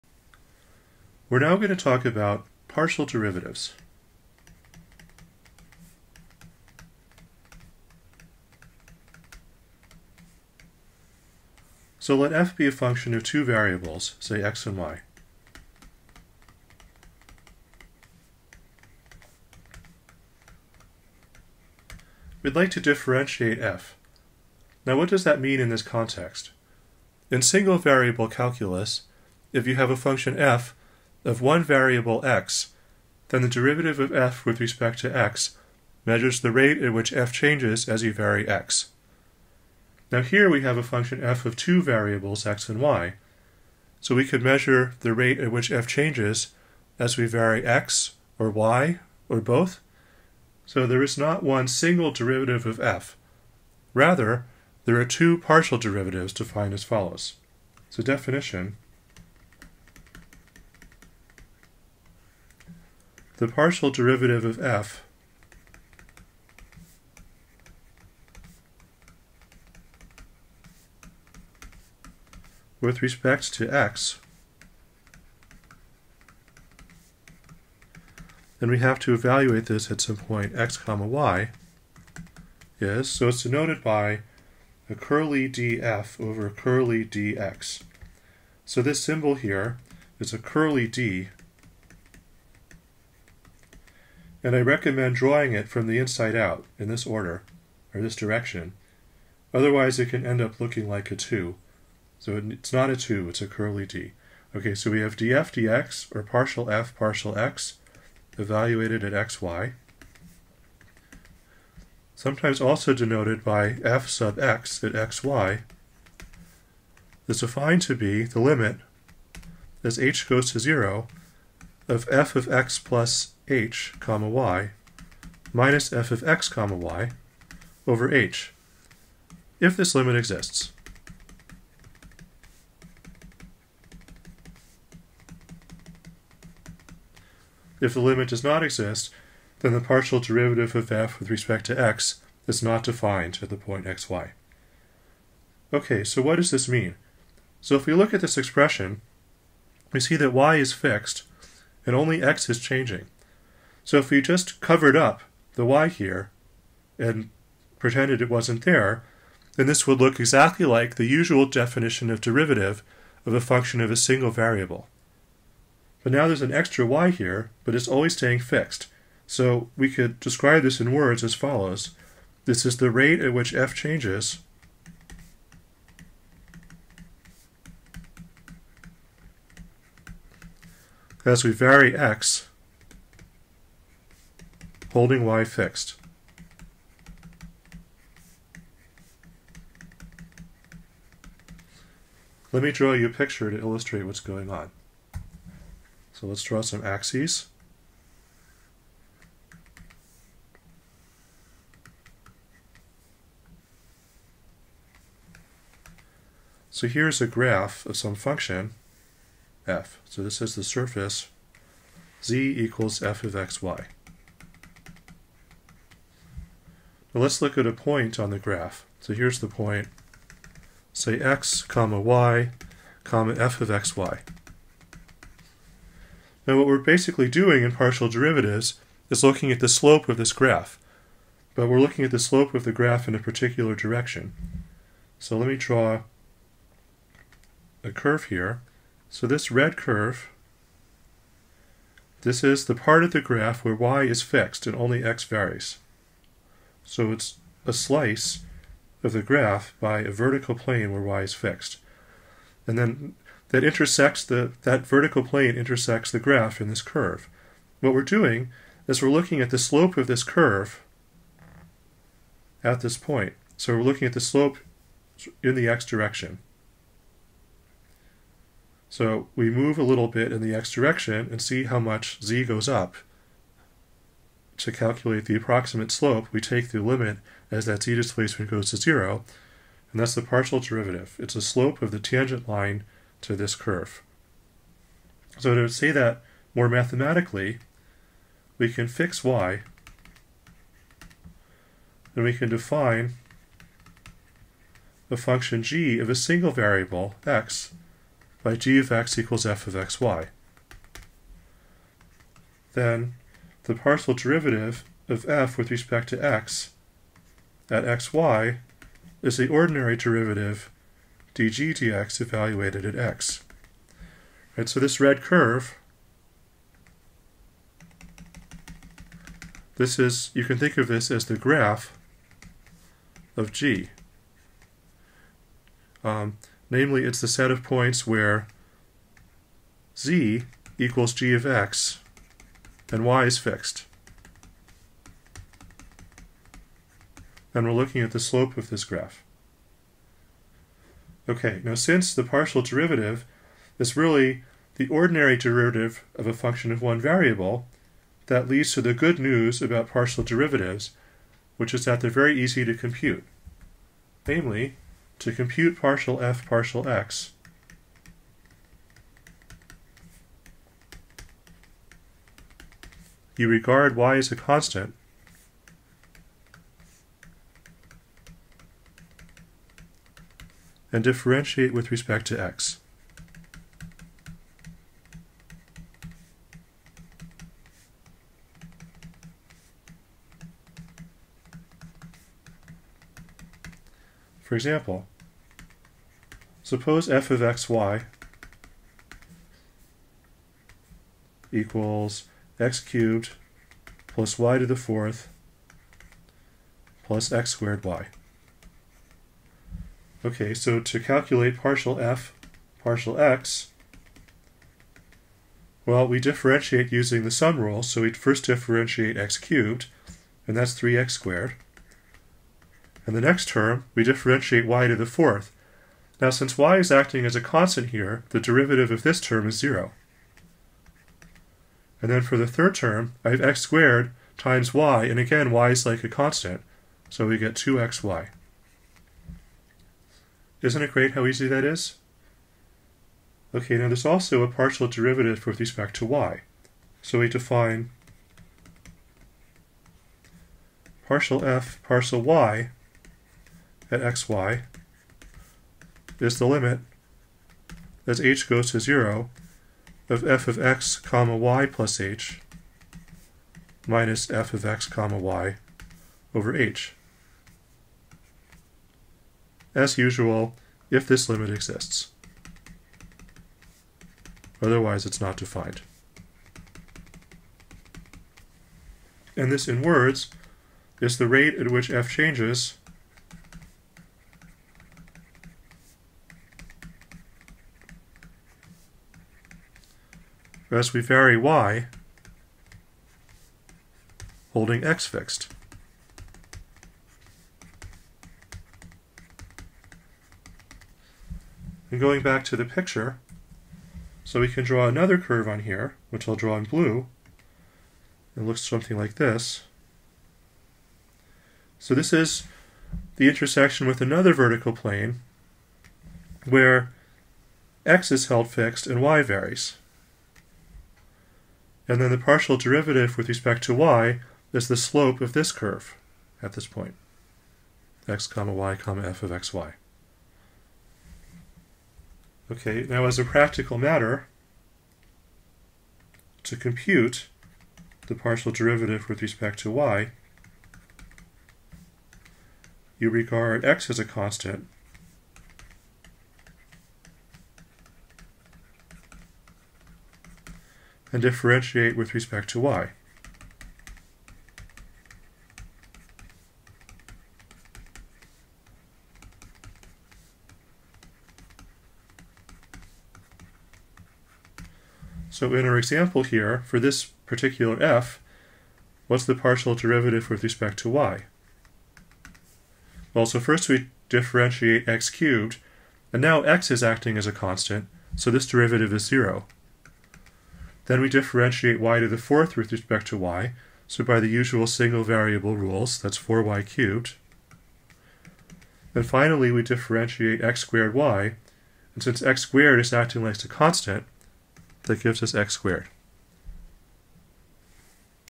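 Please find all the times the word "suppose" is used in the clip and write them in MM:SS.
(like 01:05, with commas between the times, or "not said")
06:26.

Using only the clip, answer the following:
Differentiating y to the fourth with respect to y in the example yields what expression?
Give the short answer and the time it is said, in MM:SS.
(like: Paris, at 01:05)
4y cubed, at 09:36.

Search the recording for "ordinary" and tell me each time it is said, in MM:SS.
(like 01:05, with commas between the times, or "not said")
05:09, 05:44.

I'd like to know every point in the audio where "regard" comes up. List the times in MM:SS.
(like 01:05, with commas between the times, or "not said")
06:03, 08:53.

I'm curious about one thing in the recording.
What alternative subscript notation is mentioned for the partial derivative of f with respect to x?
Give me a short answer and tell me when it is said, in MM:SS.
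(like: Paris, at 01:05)
f sub x, at 01:53.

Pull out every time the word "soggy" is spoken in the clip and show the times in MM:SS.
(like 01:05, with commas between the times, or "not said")
not said.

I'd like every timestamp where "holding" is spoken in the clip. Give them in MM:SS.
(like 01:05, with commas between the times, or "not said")
03:04, 08:04.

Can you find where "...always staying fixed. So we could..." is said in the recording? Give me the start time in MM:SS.
02:47.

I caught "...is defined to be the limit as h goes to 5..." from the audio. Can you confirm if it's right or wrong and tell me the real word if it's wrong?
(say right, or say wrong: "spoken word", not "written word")
wrong: "0", not "5".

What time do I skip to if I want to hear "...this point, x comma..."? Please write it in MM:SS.
08:36.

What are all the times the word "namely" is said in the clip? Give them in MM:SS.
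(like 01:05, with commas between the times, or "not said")
05:26, 05:54.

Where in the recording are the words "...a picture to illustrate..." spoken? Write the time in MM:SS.
03:13.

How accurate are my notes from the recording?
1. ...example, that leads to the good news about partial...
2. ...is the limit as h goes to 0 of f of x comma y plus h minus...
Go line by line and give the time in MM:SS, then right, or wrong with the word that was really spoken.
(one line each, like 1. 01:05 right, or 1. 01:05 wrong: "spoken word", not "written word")
1. 05:46 wrong: "variable", not "example"
2. 07:26 right.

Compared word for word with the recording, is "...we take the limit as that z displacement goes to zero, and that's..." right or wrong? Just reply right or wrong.
right.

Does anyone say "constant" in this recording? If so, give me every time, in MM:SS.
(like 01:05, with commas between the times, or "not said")
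06:04, 06:57, 07:06, 08:54, 09:27, 09:43.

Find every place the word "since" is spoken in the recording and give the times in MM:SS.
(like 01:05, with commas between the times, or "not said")
05:41, 06:56, 09:42.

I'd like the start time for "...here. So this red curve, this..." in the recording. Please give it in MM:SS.
03:58.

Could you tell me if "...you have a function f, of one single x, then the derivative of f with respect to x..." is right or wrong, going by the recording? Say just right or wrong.
wrong.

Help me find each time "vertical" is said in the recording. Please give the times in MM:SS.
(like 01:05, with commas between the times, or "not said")
04:10, 04:14, 08:24.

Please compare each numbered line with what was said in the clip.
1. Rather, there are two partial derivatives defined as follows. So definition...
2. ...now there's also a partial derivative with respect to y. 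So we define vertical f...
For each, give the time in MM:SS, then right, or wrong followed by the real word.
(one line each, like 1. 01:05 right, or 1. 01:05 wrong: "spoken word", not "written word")
1. 00:53 right
2. 07:13 wrong: "partial", not "vertical".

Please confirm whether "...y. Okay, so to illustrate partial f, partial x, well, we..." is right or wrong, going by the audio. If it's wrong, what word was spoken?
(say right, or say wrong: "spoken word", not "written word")
wrong: "calculate", not "illustrate".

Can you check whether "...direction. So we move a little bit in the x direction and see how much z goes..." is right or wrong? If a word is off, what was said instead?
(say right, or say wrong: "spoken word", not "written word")
right.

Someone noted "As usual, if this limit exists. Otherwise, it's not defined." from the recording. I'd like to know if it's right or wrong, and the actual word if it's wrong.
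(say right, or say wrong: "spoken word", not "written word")
right.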